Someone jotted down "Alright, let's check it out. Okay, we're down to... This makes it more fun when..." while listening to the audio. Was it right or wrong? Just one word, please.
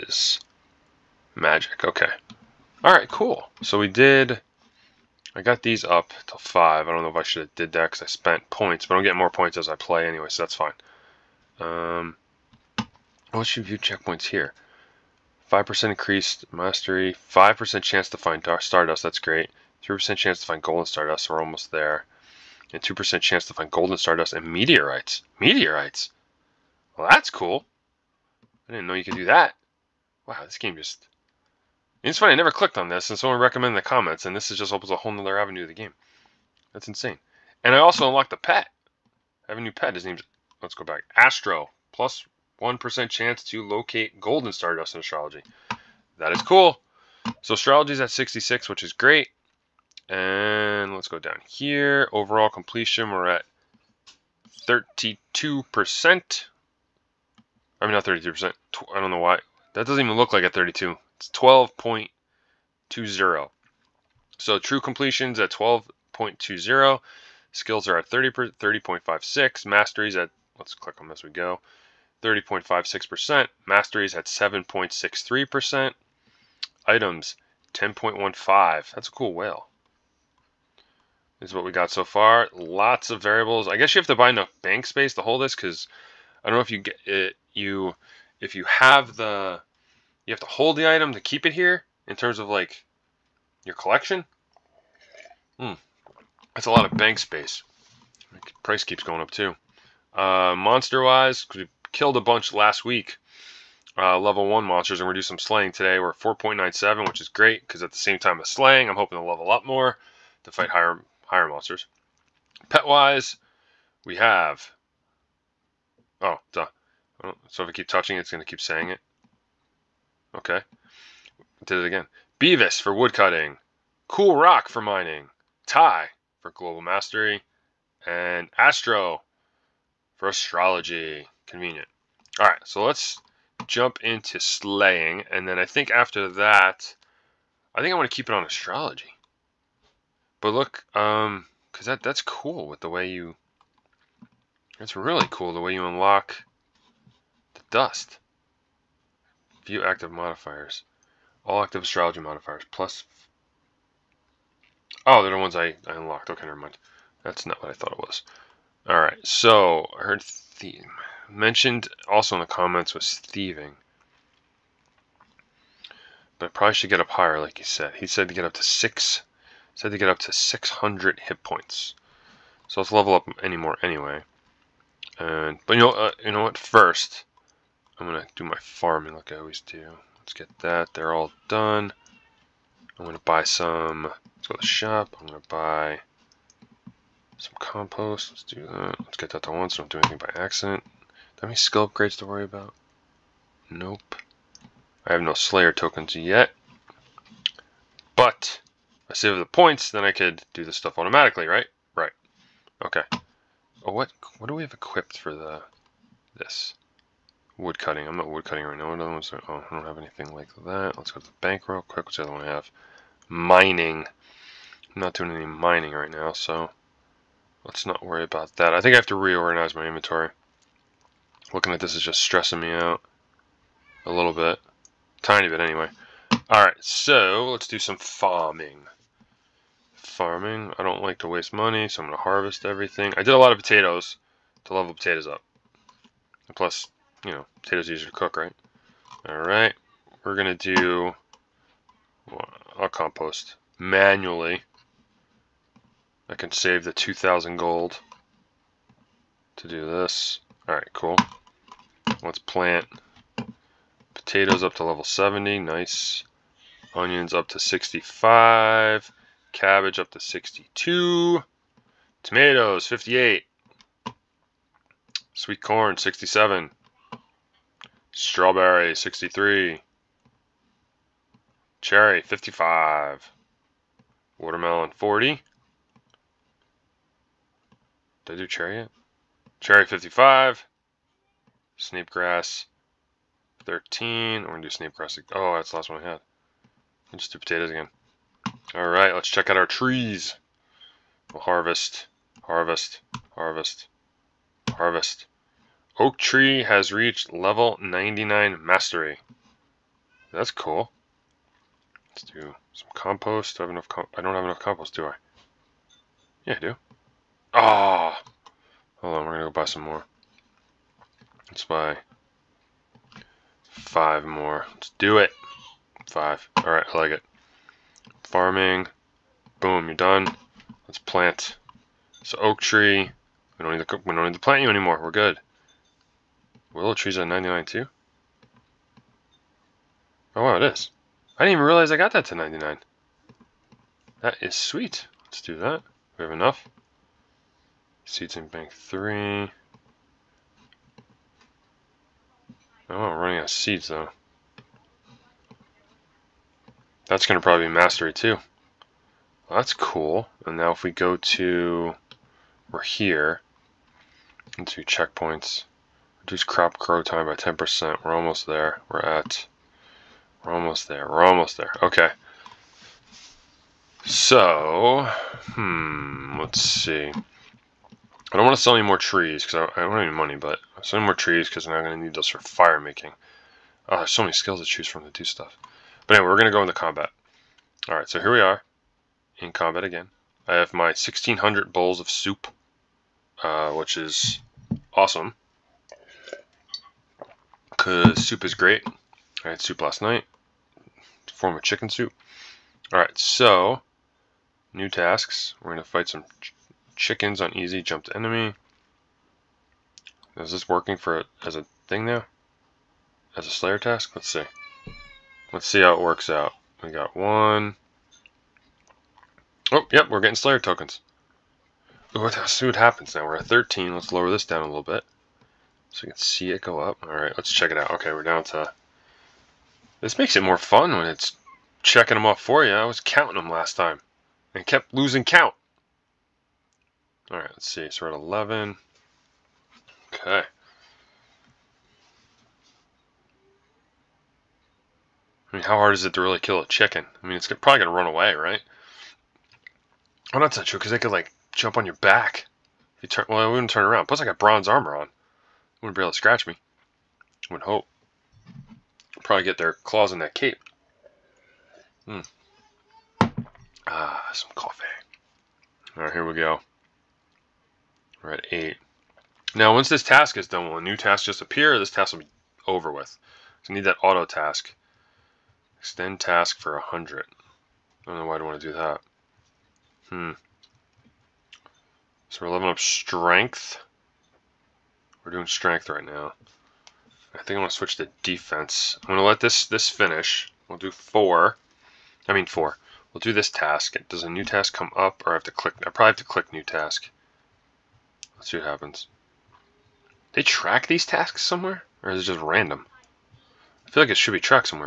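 right.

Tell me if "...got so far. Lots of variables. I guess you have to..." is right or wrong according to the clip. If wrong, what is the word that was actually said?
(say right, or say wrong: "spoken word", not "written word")
right.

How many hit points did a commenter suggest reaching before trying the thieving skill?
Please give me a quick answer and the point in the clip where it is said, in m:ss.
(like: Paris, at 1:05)
600, at 2:50.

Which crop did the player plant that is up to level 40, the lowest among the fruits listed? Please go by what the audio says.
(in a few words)
Watermelon.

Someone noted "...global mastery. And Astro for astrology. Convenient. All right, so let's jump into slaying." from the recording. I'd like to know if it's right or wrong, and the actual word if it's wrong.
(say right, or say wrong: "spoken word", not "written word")
right.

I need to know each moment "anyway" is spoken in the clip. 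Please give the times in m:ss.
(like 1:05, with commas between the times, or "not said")
0:10, 2:53, 3:45, 6:16.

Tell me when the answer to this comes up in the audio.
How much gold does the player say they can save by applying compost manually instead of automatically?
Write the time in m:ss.
4:06.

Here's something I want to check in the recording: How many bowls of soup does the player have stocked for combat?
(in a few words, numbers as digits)
1600.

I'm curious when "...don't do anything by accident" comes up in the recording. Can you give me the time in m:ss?
3:09.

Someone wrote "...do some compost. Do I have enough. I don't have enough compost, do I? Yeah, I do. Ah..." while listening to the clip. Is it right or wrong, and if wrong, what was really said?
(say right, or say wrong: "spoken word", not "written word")
right.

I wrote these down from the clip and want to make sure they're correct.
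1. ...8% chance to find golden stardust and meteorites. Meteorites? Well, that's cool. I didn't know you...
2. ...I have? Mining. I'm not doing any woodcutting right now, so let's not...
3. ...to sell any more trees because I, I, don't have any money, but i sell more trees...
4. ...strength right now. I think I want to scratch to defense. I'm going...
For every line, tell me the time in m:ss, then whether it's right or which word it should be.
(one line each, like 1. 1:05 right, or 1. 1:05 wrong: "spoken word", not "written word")
1. 0:22 wrong: "2", not "8"
2. 3:32 wrong: "mining", not "woodcutting"
3. 6:08 right
4. 7:55 wrong: "switch", not "scratch".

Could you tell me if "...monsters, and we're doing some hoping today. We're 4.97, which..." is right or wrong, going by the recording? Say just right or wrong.
wrong.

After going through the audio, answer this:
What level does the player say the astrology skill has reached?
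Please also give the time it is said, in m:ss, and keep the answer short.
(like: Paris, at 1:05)
66, at 0:48.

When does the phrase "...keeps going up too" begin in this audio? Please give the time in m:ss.
1:38.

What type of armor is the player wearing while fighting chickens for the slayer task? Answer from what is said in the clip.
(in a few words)
Bronze.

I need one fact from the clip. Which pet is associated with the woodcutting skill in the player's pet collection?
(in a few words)
Beavis.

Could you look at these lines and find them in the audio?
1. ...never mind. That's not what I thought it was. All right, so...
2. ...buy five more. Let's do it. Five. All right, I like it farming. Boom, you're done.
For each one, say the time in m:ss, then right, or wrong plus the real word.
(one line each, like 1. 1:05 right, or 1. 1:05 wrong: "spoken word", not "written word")
1. 2:36 right
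2. 5:11 right.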